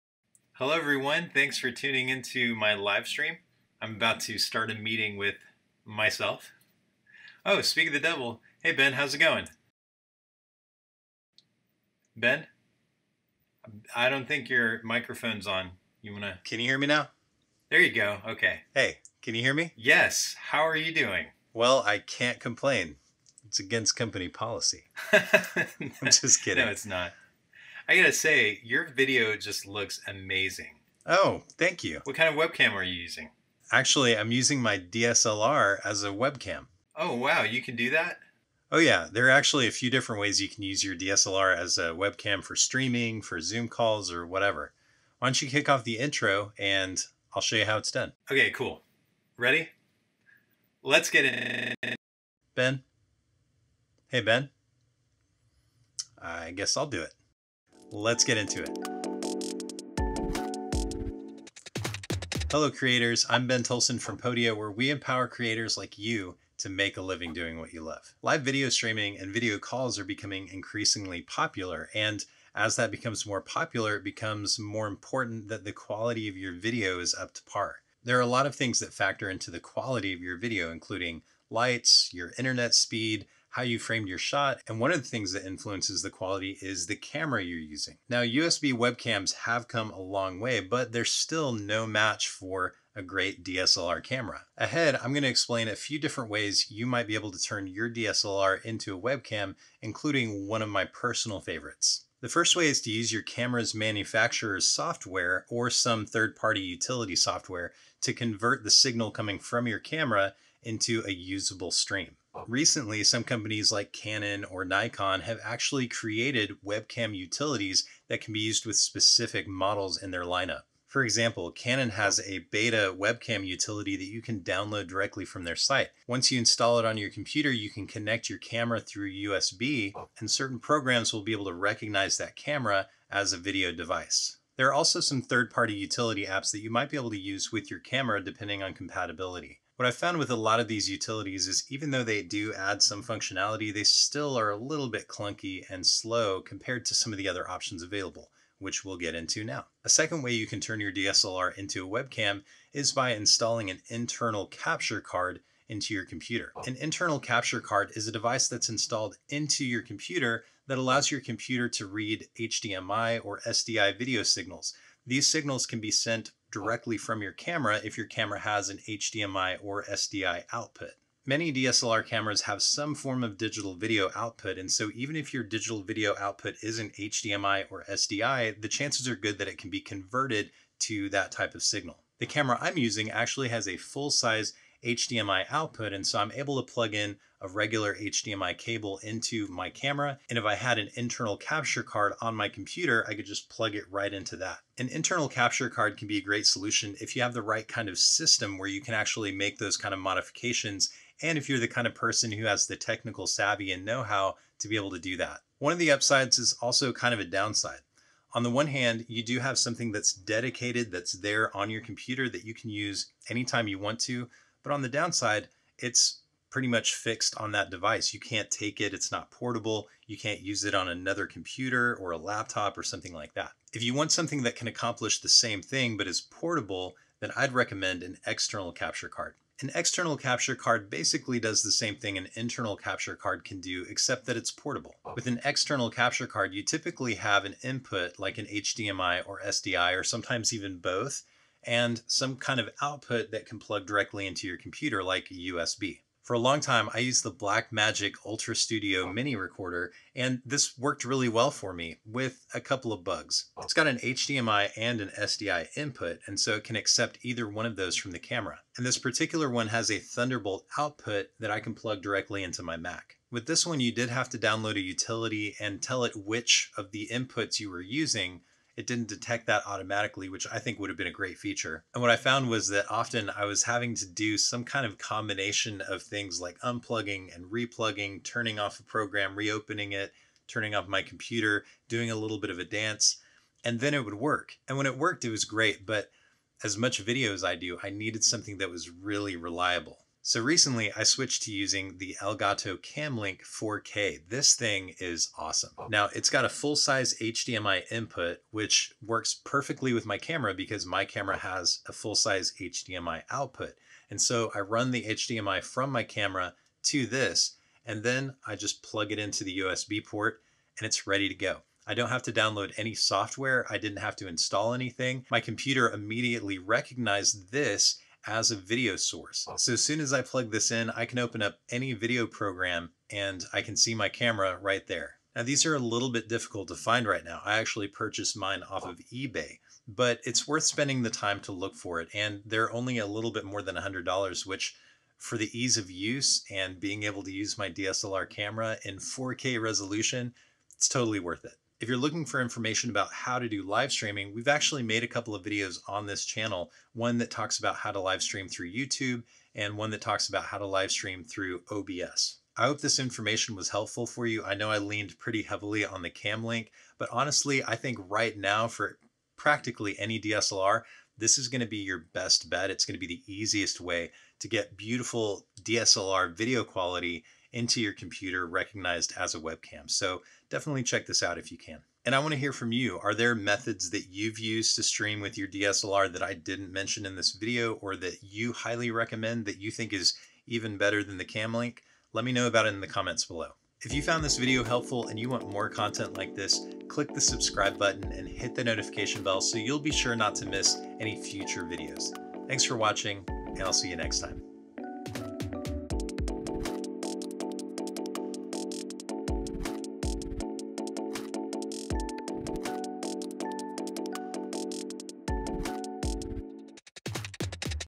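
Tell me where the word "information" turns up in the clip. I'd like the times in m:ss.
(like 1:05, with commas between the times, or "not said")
5:42, 5:52.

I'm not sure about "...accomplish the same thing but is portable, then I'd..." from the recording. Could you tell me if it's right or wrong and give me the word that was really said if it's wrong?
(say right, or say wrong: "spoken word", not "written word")
right.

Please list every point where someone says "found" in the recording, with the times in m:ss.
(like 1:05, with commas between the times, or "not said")
2:19, 4:32, 6:24.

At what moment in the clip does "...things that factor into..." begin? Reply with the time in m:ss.
1:18.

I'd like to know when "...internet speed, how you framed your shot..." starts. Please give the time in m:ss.
1:22.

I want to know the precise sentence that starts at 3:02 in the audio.
The camera I'm using actually has a full size HDMI output.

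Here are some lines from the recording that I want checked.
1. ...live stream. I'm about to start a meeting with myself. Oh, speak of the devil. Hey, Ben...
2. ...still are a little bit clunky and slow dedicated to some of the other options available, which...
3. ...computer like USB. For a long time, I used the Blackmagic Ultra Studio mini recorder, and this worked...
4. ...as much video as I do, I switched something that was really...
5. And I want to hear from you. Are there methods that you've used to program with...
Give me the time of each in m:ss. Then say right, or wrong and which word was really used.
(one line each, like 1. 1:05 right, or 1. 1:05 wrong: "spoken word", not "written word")
1. 0:02 right
2. 2:23 wrong: "compared", not "dedicated"
3. 4:04 right
4. 4:46 wrong: "needed", not "switched"
5. 6:12 wrong: "stream", not "program".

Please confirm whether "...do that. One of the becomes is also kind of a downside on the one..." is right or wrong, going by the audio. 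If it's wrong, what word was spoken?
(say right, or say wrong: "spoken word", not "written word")
wrong: "upsides", not "becomes".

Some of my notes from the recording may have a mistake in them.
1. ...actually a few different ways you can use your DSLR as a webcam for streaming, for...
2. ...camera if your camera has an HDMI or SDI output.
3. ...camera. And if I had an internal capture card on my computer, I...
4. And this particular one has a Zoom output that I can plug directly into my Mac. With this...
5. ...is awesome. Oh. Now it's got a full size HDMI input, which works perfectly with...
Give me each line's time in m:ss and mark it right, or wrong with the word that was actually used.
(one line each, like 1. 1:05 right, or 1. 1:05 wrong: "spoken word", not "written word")
1. 0:39 right
2. 2:47 right
3. 3:09 right
4. 4:18 wrong: "Thunderbolt", not "Zoom"
5. 4:54 right.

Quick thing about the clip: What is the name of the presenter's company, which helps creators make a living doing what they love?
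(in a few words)
Podia.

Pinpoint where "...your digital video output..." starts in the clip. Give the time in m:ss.
2:55.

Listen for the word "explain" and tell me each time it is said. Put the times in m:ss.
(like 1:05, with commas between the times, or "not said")
1:35.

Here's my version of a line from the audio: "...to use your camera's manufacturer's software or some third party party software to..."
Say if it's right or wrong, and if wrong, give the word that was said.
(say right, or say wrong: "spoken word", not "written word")
wrong: "utility", not "party".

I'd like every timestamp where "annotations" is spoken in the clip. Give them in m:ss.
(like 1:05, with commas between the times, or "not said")
not said.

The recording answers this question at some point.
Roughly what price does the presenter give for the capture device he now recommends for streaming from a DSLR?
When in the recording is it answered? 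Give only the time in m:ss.
5:33.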